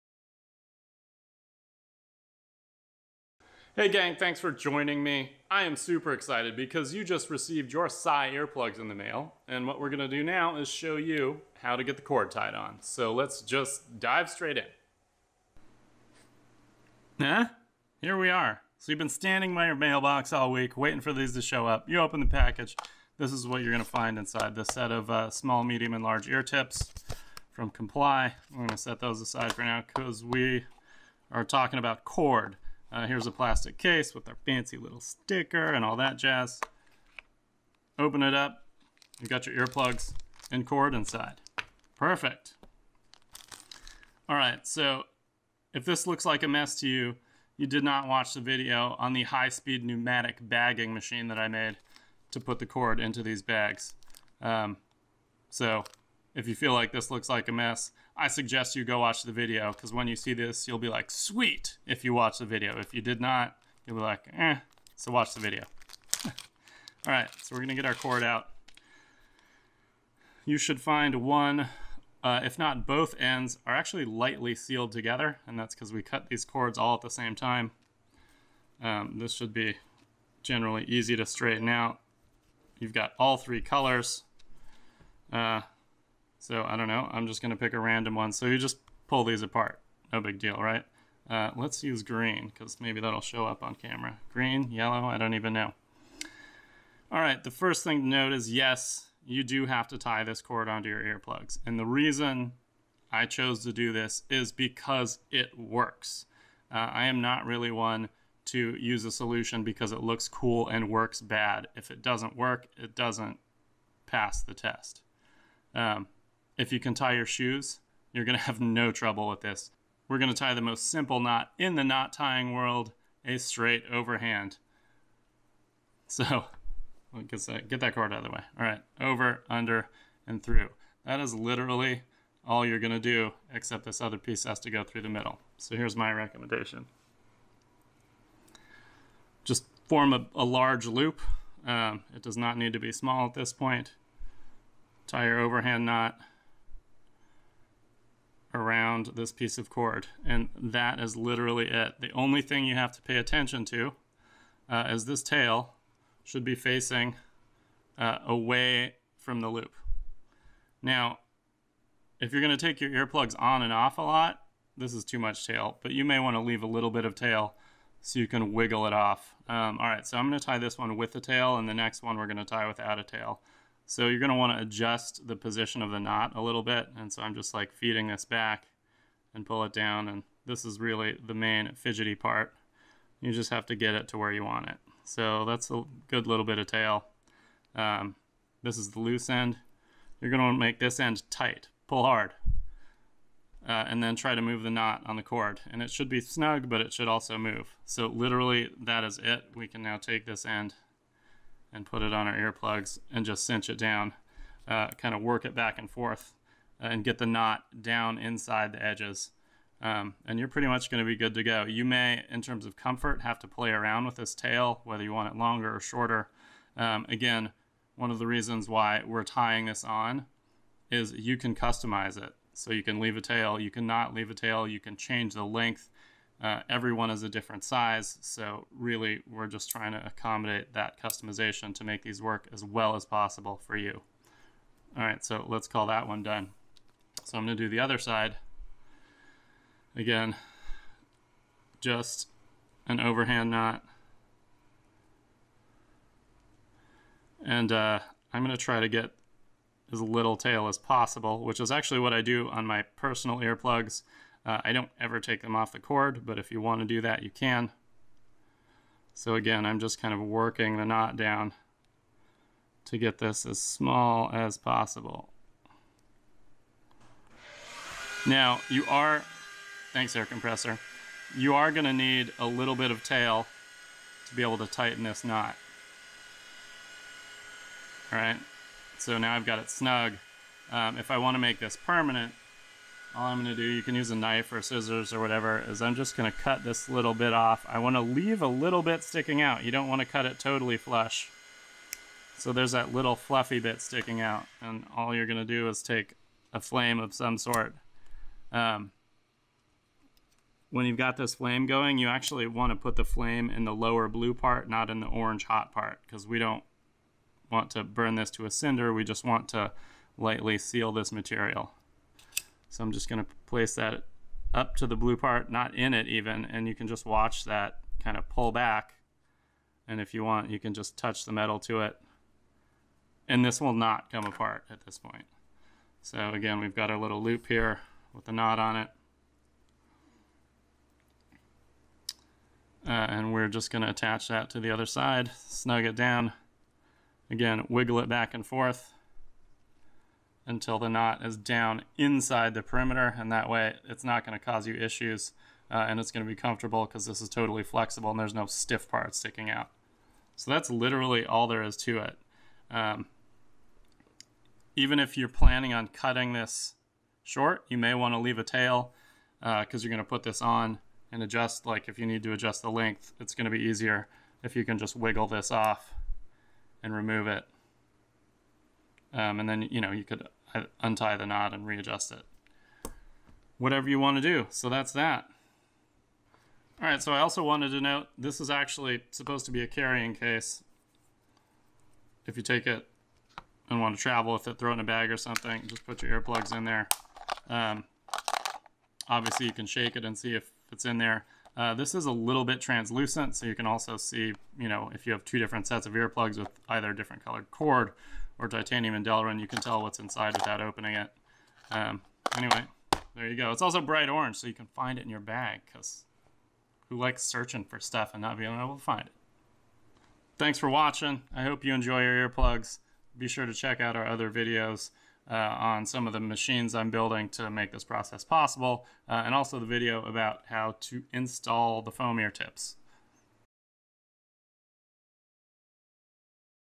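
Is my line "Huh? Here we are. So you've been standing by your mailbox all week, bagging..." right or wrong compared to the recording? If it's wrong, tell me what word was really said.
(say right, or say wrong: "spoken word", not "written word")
wrong: "waiting", not "bagging".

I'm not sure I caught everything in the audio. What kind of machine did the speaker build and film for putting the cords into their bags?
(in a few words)
high-speed pneumatic bagging machine.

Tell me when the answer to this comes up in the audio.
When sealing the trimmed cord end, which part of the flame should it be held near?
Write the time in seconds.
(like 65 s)
303 s.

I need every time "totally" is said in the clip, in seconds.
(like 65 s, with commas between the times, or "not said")
290 s, 347 s.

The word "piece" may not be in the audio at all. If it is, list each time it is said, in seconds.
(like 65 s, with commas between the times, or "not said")
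134 s, 149 s.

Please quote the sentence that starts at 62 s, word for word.
If you did not, you'll be like, eh, so watch the video.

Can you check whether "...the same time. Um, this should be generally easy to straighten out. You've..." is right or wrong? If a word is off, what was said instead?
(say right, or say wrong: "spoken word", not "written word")
right.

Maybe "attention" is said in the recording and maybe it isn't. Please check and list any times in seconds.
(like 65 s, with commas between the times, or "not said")
153 s.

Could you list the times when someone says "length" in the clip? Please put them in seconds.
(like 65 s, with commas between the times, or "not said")
225 s, 362 s.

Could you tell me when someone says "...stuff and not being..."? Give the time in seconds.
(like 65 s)
407 s.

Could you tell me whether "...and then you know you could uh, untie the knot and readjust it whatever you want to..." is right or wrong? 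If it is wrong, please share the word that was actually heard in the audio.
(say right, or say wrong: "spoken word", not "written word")
right.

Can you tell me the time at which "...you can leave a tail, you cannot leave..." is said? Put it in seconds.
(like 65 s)
222 s.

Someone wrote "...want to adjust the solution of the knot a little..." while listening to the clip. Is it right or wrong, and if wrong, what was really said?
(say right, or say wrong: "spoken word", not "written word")
wrong: "position", not "solution".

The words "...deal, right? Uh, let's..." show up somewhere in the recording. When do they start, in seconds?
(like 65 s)
90 s.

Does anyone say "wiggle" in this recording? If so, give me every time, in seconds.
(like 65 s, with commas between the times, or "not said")
168 s, 337 s, 364 s.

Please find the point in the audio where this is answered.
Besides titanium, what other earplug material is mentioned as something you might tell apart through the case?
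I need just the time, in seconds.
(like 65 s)
399 s.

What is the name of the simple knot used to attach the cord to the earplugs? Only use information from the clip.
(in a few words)
straight overhand.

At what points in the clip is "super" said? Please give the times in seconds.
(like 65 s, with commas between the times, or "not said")
5 s.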